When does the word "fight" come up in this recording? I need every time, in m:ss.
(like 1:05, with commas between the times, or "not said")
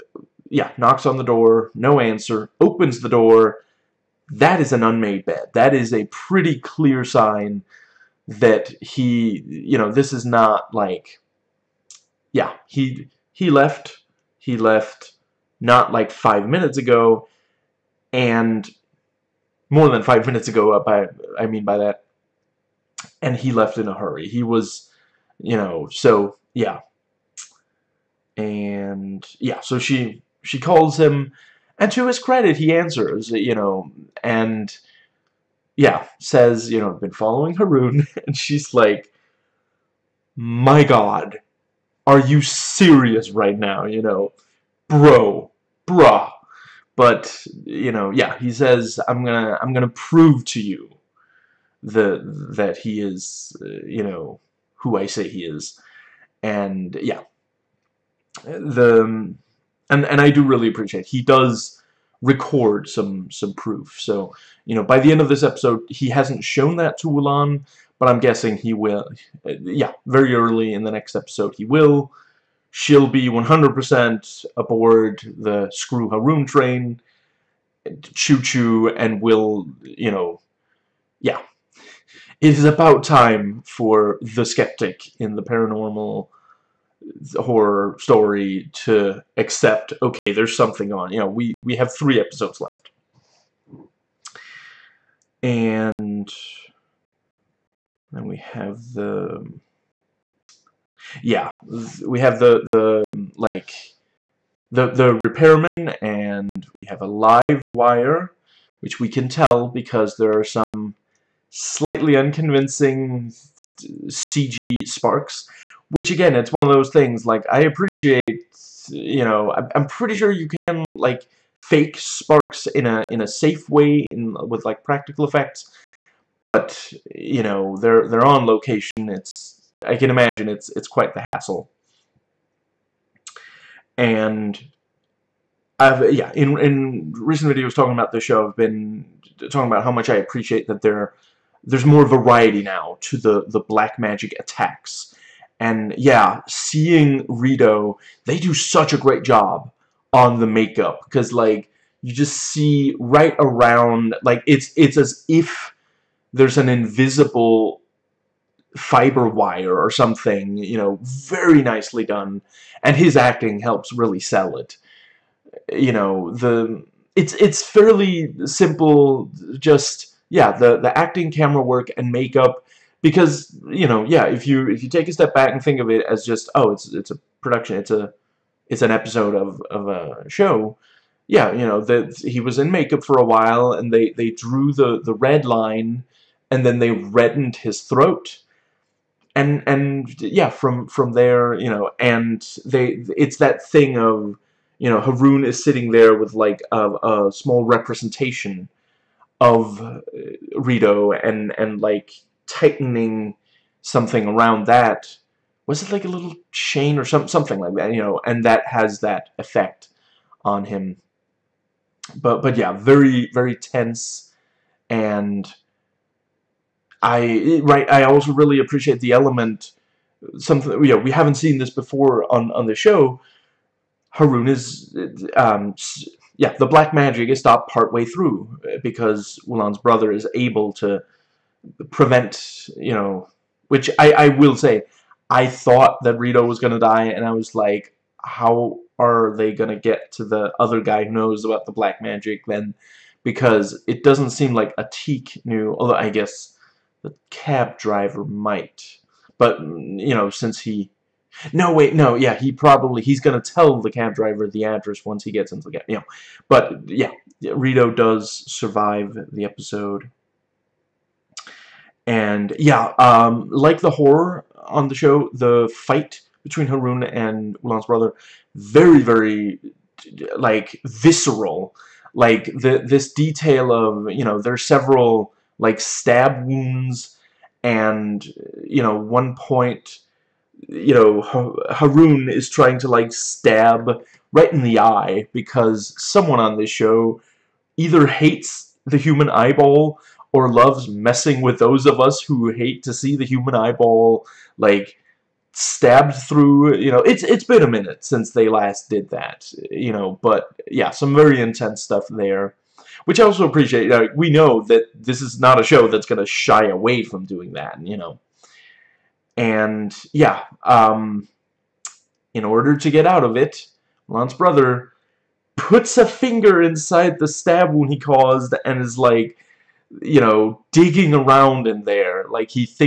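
4:25.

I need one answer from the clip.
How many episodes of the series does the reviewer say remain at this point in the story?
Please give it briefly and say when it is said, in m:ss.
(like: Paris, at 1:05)
3, at 1:31.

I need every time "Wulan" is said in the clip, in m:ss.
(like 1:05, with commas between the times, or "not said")
1:07, 3:49, 4:27, 5:14.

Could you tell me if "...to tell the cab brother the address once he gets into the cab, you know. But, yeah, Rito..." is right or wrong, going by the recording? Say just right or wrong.
wrong.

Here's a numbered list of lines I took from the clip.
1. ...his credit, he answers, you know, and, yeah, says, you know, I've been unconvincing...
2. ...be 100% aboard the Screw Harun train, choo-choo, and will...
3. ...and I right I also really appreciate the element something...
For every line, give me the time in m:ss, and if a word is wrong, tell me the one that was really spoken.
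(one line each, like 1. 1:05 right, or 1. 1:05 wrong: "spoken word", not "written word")
1. 0:32 wrong: "following", not "unconvincing"
2. 1:13 right
3. 3:34 right.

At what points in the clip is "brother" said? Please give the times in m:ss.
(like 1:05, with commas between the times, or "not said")
3:49, 4:27, 5:14.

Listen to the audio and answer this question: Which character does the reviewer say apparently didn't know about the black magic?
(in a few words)
Atik.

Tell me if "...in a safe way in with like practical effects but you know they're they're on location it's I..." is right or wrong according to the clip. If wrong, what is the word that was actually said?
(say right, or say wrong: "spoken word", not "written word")
right.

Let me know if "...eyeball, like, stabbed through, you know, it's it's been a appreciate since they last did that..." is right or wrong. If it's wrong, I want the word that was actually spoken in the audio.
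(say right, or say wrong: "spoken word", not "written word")
wrong: "minute", not "appreciate".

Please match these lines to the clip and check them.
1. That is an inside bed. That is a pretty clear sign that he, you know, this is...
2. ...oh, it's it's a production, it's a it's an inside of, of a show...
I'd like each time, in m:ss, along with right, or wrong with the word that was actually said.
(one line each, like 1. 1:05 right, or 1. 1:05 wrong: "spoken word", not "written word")
1. 0:04 wrong: "unmade", not "inside"
2. 2:56 wrong: "episode", not "inside".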